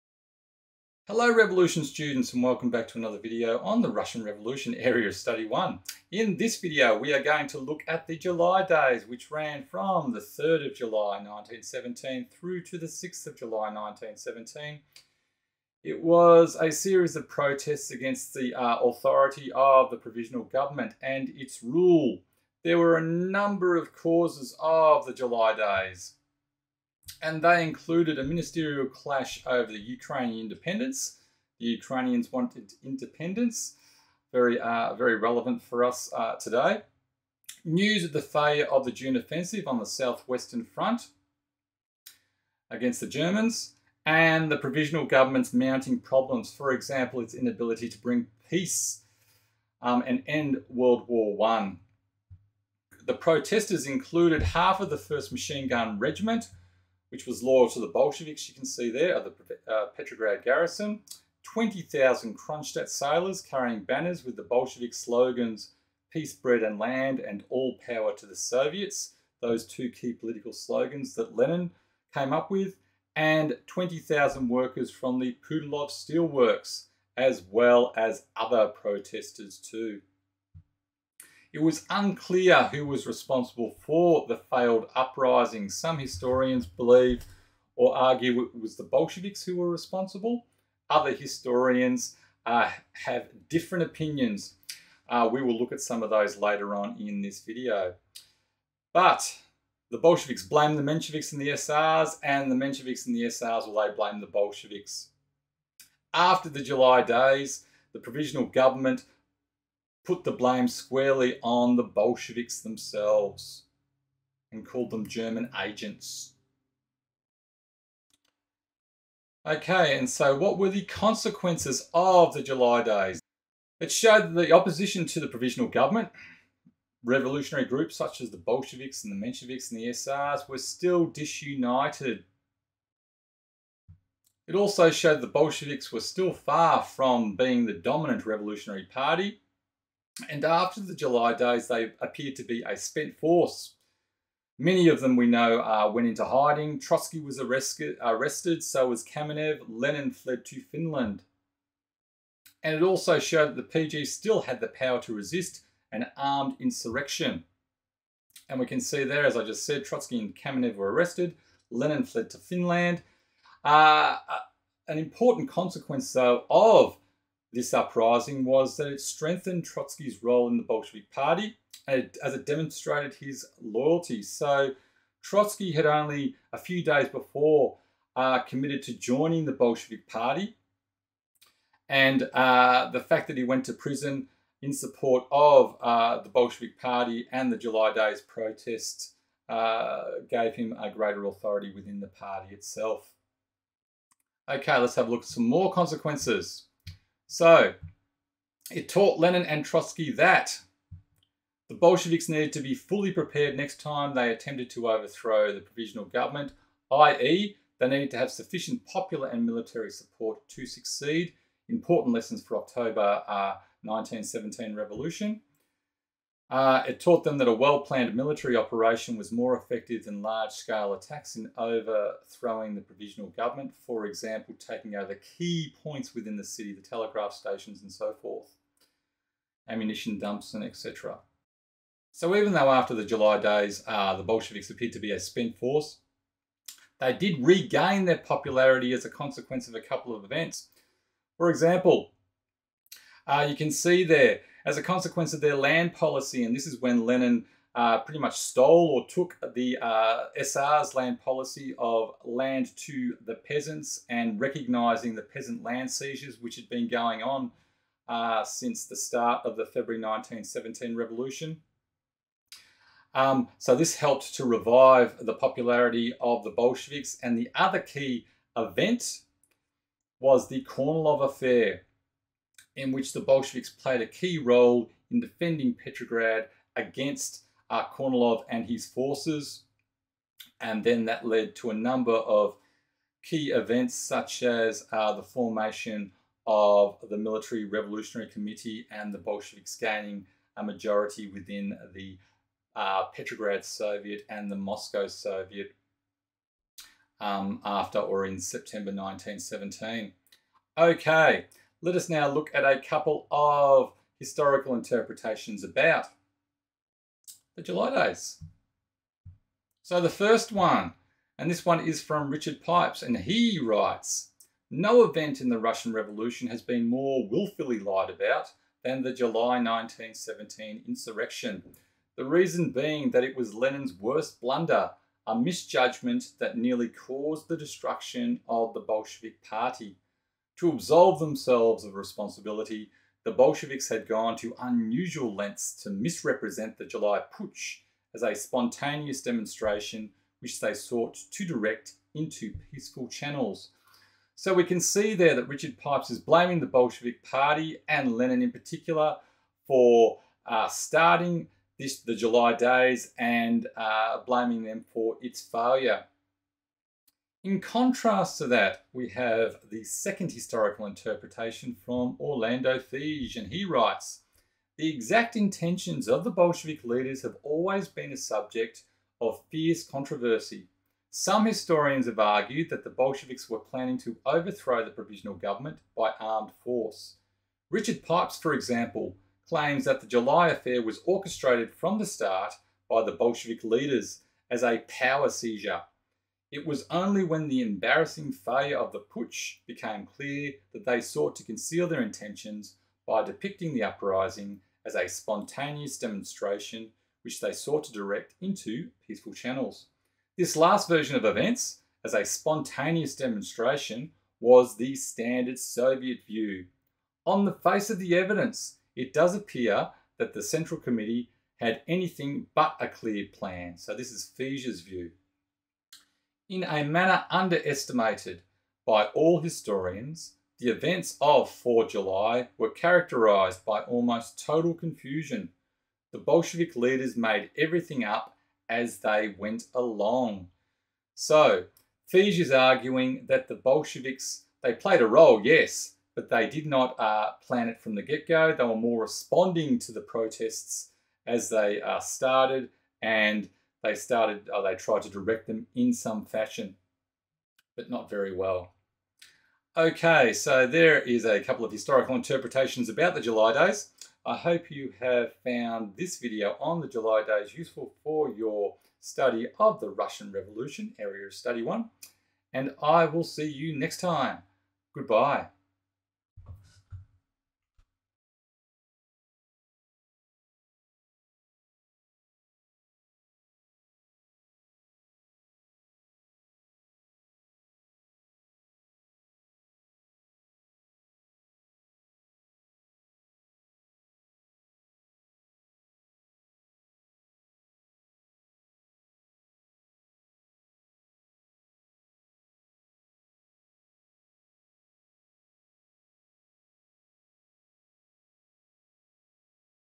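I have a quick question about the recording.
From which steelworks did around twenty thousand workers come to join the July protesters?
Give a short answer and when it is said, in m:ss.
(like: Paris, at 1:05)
Putilov Steelworks, at 1:15.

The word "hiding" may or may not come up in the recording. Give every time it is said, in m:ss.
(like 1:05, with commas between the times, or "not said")
2:26.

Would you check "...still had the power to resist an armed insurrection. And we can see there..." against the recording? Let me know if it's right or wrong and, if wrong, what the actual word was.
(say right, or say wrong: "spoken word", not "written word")
right.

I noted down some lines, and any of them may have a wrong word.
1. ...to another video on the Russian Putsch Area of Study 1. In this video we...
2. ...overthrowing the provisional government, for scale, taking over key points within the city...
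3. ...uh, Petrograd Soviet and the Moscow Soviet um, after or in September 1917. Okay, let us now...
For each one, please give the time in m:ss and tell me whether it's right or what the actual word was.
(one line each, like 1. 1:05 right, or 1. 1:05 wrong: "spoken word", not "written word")
1. 0:02 wrong: "Revolution", not "Putsch"
2. 3:41 wrong: "example", not "scale"
3. 4:52 right.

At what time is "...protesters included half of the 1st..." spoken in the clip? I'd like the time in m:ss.
0:53.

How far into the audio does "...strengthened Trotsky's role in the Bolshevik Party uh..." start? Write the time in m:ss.
2:49.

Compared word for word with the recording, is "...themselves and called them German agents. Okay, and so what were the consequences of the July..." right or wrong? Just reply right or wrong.
right.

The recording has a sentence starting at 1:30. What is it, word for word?
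Other historians uh, have different opinions.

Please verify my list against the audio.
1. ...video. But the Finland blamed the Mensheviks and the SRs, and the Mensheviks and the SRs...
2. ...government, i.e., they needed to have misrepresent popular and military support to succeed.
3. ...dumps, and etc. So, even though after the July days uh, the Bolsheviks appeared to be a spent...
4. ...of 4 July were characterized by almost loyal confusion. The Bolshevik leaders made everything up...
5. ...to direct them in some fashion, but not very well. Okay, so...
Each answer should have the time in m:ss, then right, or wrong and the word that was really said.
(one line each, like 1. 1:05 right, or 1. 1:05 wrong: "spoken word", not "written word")
1. 1:37 wrong: "Bolsheviks", not "Finland"
2. 3:26 wrong: "sufficient", not "misrepresent"
3. 3:50 right
4. 7:01 wrong: "total", not "loyal"
5. 7:25 right.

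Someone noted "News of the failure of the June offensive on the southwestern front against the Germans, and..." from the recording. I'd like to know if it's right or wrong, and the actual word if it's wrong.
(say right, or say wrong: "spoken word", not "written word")
right.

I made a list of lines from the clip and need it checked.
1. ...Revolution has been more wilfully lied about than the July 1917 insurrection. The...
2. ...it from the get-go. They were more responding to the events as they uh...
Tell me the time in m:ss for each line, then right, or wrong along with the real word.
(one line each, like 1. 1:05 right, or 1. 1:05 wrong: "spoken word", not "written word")
1. 5:15 right
2. 7:17 wrong: "protests", not "events".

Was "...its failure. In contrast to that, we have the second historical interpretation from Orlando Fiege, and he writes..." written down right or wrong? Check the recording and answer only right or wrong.
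right.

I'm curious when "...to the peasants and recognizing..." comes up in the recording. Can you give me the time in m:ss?
4:12.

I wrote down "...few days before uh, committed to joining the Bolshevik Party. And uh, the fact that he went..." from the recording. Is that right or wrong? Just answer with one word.
right.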